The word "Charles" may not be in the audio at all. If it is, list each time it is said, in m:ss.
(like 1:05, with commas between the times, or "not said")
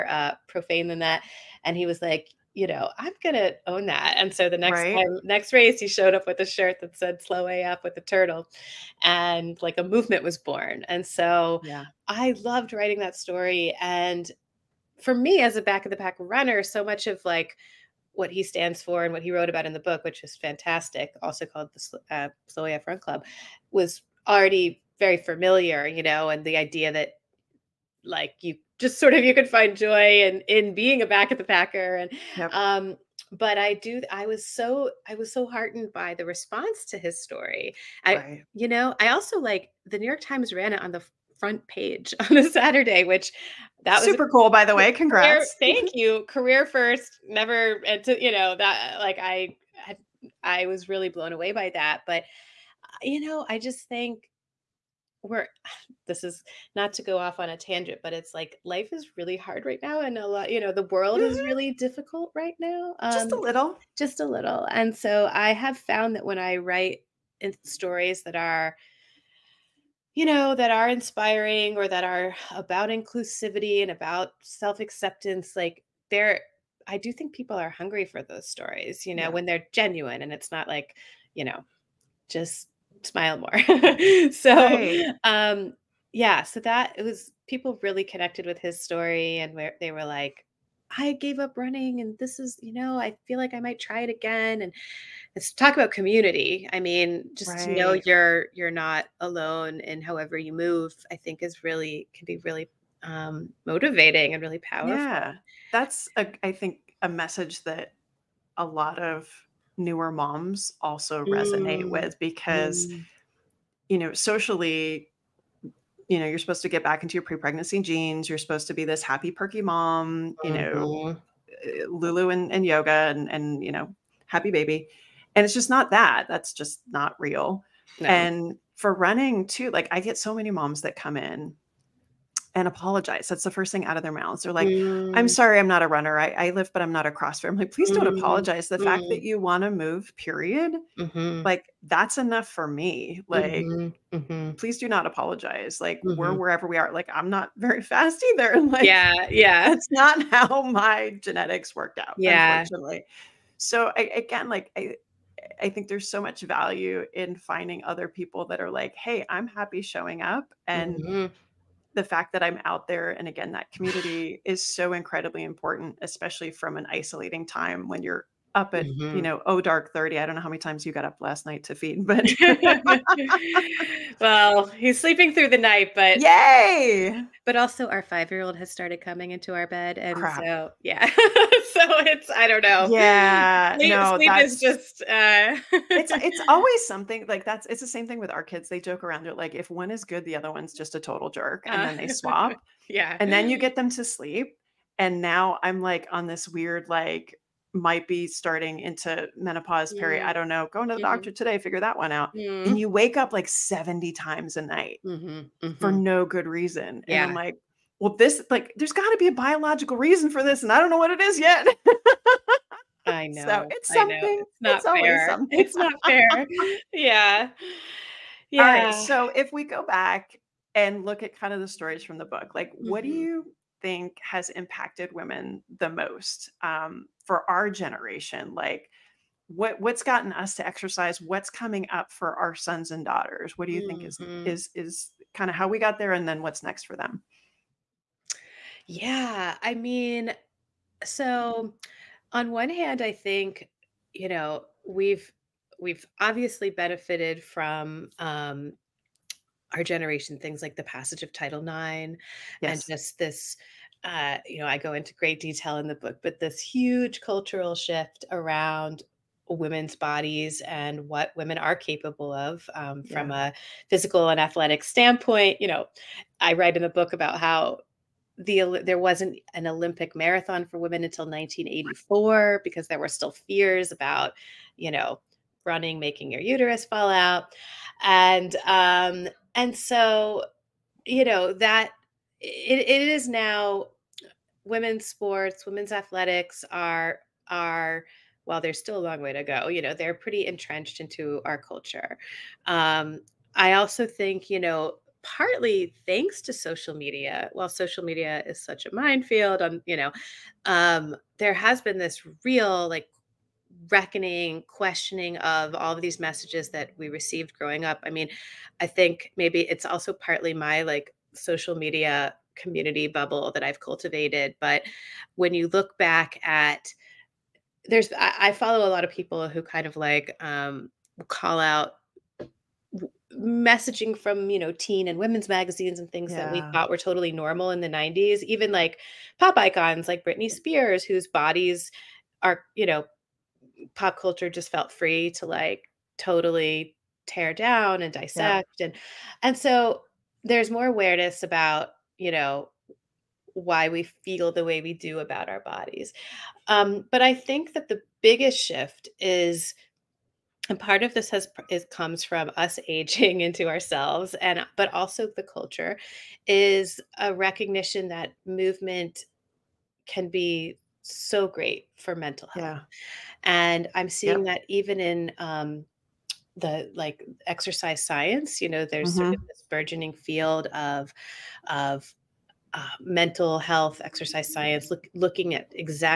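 not said.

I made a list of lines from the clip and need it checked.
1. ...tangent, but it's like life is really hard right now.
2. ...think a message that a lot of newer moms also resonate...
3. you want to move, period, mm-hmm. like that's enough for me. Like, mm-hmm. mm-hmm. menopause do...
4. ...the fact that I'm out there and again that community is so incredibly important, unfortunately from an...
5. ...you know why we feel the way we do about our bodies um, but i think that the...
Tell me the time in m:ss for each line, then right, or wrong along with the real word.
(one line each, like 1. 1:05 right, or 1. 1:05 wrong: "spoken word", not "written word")
1. 0:57 right
2. 1:46 right
3. 2:19 wrong: "please", not "menopause"
4. 2:41 wrong: "especially", not "unfortunately"
5. 5:42 right.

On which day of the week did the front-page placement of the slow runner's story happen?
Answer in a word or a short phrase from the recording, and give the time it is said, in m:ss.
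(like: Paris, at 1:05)
Saturday, at 0:42.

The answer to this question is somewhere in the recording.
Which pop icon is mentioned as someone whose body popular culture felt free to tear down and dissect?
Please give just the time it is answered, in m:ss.
5:30.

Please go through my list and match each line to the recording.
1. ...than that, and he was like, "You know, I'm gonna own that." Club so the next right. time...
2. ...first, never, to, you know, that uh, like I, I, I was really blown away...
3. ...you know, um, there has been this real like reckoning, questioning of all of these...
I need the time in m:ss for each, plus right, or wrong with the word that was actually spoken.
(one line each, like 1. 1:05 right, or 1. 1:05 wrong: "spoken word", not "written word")
1. 0:00 wrong: "And", not "Club"
2. 0:46 right
3. 4:59 right.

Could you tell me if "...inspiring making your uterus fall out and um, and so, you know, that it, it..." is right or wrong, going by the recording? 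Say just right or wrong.
wrong.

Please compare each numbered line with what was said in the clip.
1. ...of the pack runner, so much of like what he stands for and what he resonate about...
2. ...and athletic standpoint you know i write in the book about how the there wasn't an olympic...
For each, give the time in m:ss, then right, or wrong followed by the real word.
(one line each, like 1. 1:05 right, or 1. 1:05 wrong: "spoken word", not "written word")
1. 0:15 wrong: "wrote", not "resonate"
2. 4:24 right.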